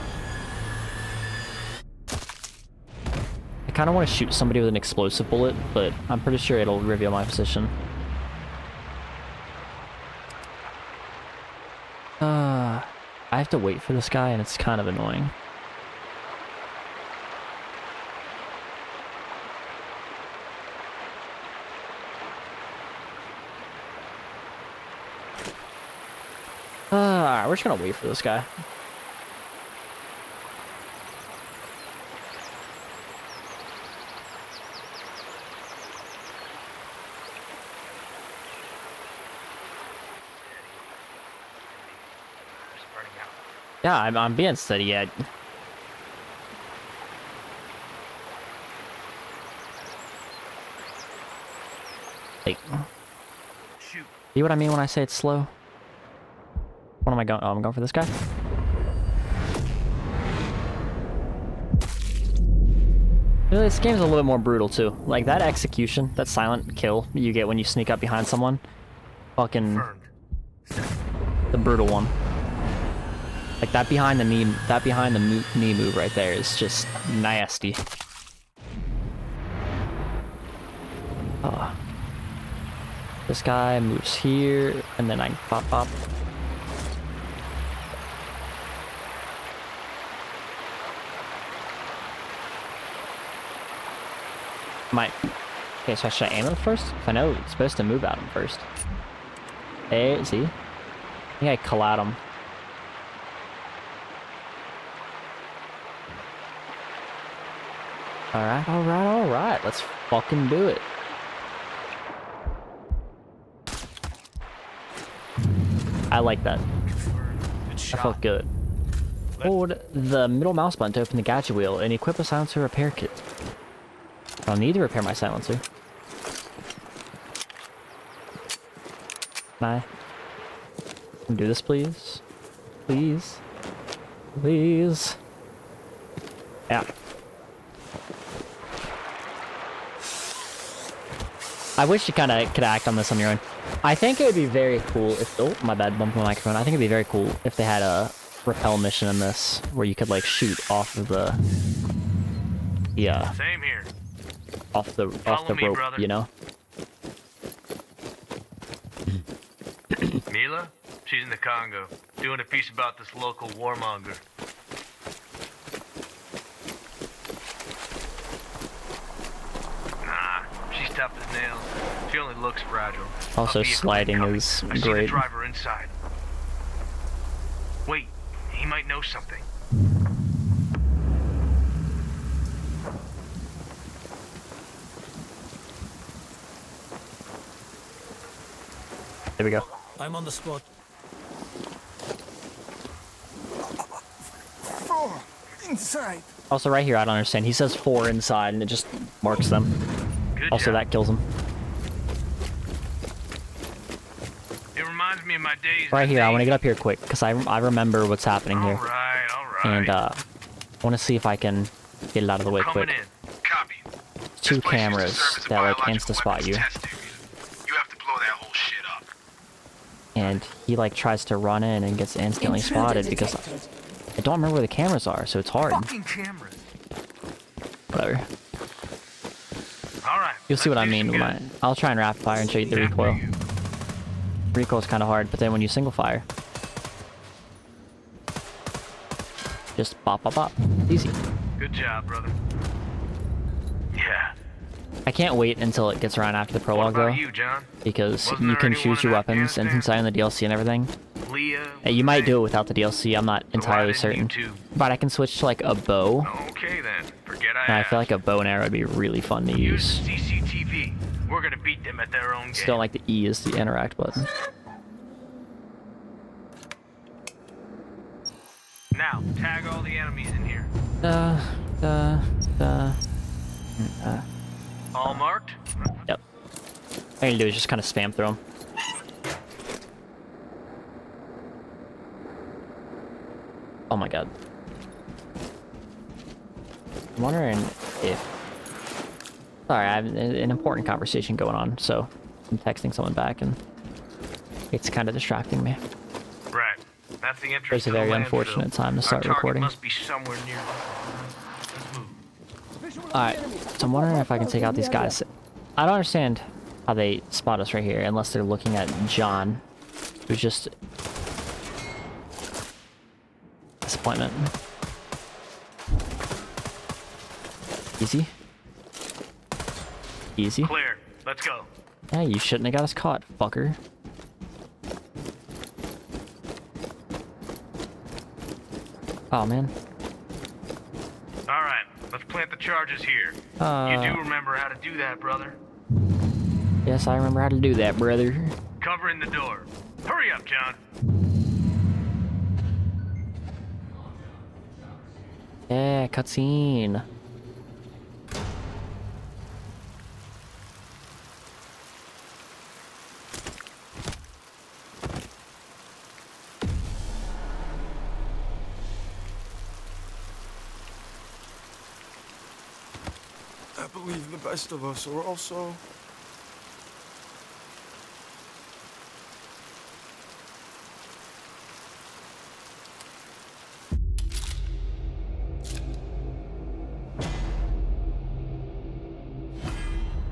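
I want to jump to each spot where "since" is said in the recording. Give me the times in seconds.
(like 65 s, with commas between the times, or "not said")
249 s.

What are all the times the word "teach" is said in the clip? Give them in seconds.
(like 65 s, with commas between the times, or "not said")
not said.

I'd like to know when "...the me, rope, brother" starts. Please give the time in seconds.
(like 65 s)
155 s.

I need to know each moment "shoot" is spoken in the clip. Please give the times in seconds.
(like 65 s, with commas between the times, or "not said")
4 s, 150 s.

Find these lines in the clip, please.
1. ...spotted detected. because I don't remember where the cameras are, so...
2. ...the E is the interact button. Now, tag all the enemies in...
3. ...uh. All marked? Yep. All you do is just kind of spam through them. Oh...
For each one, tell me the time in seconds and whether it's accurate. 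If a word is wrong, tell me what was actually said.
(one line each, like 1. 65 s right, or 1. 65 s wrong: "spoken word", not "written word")
1. 222 s right
2. 262 s right
3. 274 s right.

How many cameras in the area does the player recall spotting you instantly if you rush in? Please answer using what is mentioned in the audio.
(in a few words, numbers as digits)
2.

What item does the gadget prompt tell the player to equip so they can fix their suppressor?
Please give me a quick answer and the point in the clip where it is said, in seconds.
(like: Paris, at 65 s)
silencer repair kit, at 122 s.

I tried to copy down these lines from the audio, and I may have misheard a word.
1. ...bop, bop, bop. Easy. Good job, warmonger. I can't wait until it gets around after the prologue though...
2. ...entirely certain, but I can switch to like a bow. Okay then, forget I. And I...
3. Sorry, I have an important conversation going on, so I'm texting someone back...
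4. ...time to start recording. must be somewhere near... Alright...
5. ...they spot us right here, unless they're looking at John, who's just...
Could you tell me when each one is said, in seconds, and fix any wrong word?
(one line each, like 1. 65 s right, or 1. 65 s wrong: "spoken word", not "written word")
1. 240 s wrong: "brother", not "warmonger"
2. 253 s right
3. 289 s right
4. 298 s right
5. 306 s right.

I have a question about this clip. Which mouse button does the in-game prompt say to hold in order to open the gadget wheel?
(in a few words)
middle mouse button.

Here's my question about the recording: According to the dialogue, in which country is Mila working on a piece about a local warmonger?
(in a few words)
the Congo.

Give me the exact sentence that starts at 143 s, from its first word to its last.
I think it would be very cool if- oh, my bad, bumped my microphone.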